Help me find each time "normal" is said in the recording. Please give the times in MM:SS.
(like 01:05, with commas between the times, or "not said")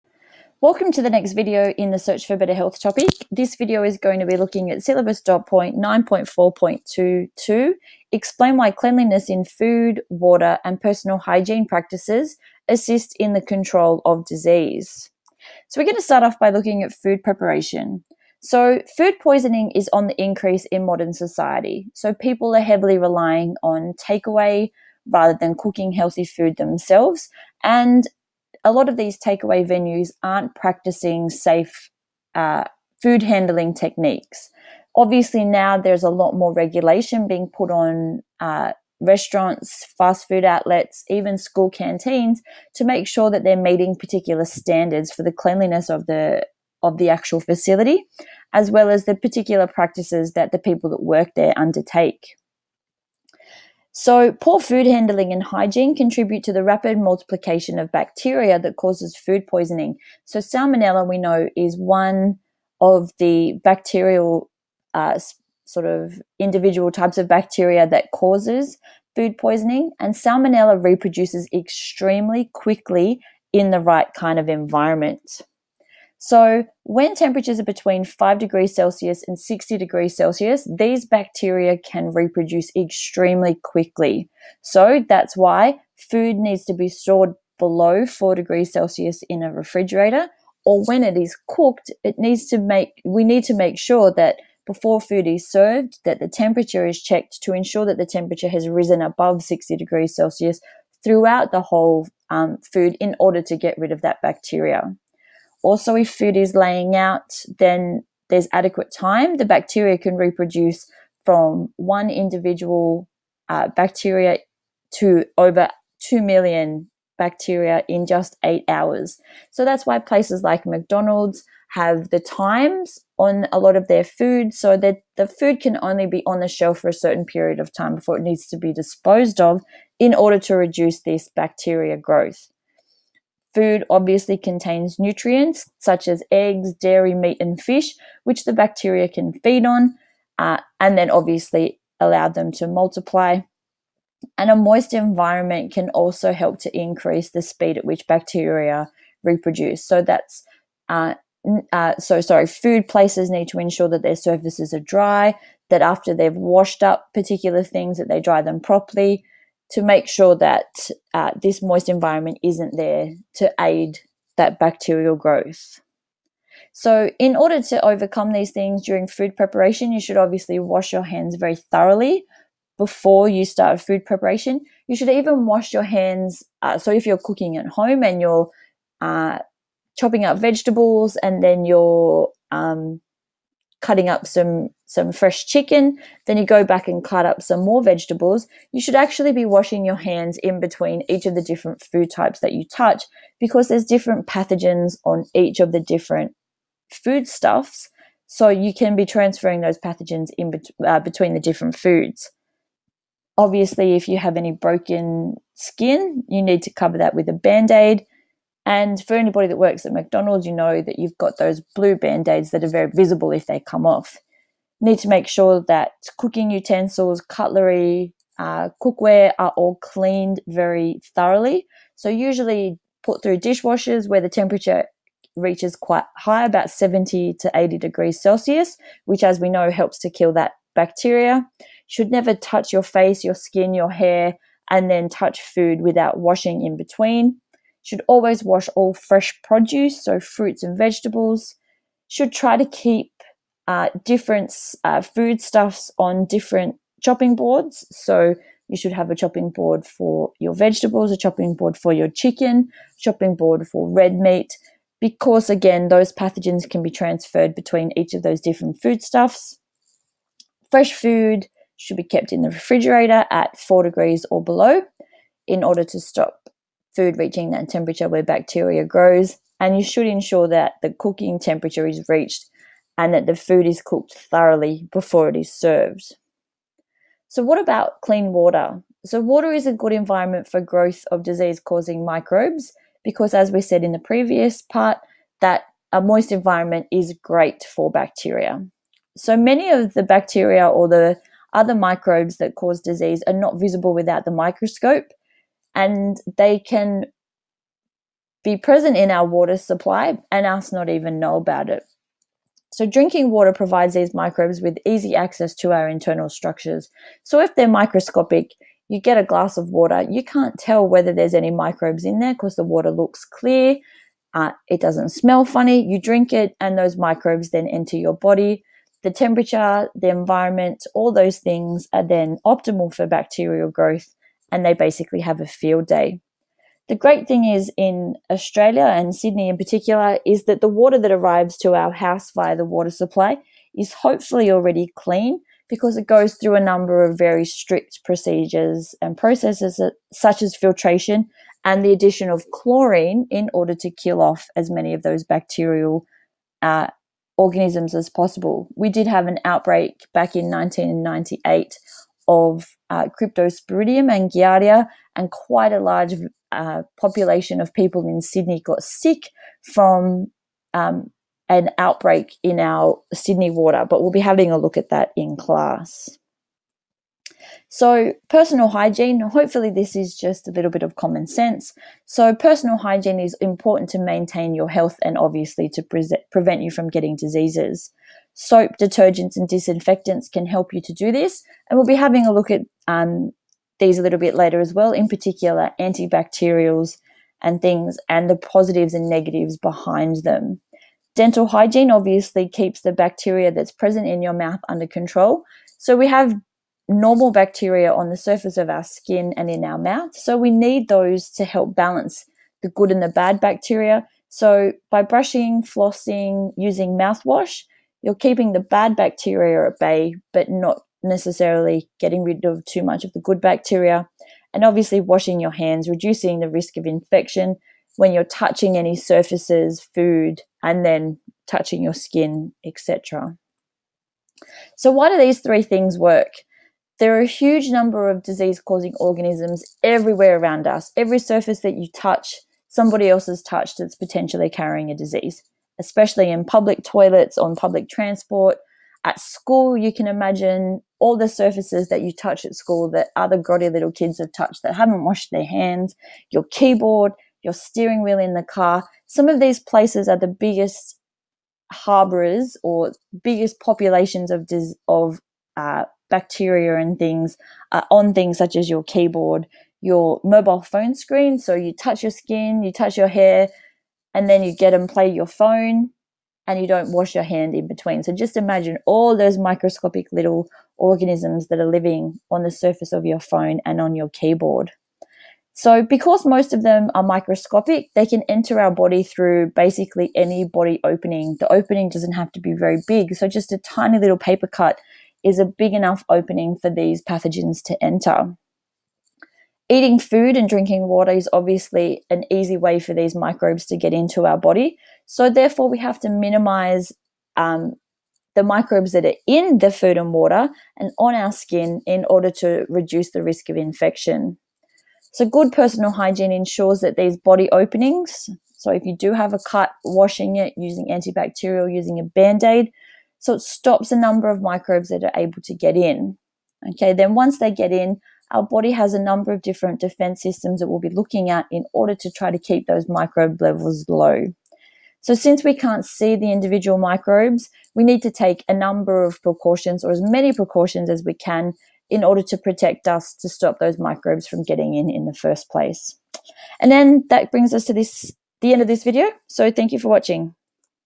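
06:36.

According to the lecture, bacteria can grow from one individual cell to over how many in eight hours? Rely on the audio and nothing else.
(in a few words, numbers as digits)
2 million.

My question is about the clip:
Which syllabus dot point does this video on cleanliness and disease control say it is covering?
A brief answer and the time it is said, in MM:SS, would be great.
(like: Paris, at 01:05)
9.4.22, at 00:05.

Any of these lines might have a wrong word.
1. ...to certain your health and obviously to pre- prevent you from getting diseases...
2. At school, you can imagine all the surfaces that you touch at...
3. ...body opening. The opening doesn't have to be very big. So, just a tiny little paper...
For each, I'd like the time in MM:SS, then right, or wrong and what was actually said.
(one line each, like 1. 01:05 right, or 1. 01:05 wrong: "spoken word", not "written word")
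1. 06:13 wrong: "maintain", not "certain"
2. 07:19 right
3. 08:00 right.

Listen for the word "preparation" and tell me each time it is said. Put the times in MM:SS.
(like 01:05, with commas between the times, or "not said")
00:17, 02:49, 02:54.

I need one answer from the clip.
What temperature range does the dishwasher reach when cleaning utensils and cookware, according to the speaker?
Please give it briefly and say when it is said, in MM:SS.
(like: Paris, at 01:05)
70 to 80 degrees Celsius, at 03:46.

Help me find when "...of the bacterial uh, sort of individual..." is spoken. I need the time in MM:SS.
01:02.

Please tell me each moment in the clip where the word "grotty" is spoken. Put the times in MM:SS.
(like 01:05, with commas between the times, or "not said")
07:23.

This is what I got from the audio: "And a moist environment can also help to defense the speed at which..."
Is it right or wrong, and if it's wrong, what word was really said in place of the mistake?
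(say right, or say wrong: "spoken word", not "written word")
wrong: "increase", not "defense".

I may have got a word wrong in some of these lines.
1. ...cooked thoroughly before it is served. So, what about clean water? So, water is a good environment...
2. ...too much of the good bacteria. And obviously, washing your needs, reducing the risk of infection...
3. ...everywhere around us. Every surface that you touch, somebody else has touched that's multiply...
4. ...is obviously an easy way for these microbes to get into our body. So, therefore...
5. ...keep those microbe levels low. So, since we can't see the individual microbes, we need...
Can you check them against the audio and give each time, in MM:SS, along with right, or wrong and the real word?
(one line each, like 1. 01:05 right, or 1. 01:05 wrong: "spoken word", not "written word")
1. 04:33 right
2. 06:52 wrong: "hands", not "needs"
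3. 07:09 wrong: "potentially", not "multiply"
4. 08:11 right
5. 08:42 right.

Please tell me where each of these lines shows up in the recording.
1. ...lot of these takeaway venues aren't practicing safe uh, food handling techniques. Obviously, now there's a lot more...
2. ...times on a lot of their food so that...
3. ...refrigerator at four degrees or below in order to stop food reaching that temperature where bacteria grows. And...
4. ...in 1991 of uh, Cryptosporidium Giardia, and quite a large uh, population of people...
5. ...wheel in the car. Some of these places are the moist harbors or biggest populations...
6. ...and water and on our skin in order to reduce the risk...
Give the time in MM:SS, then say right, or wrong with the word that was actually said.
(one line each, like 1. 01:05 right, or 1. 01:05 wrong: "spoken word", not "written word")
1. 00:28 right
2. 02:02 right
3. 04:22 right
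4. 05:50 wrong: "1998", not "1991"
5. 07:28 wrong: "biggest", not "moist"
6. 08:19 right.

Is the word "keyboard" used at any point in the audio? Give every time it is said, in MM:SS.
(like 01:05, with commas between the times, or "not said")
07:26, 07:38, 07:54.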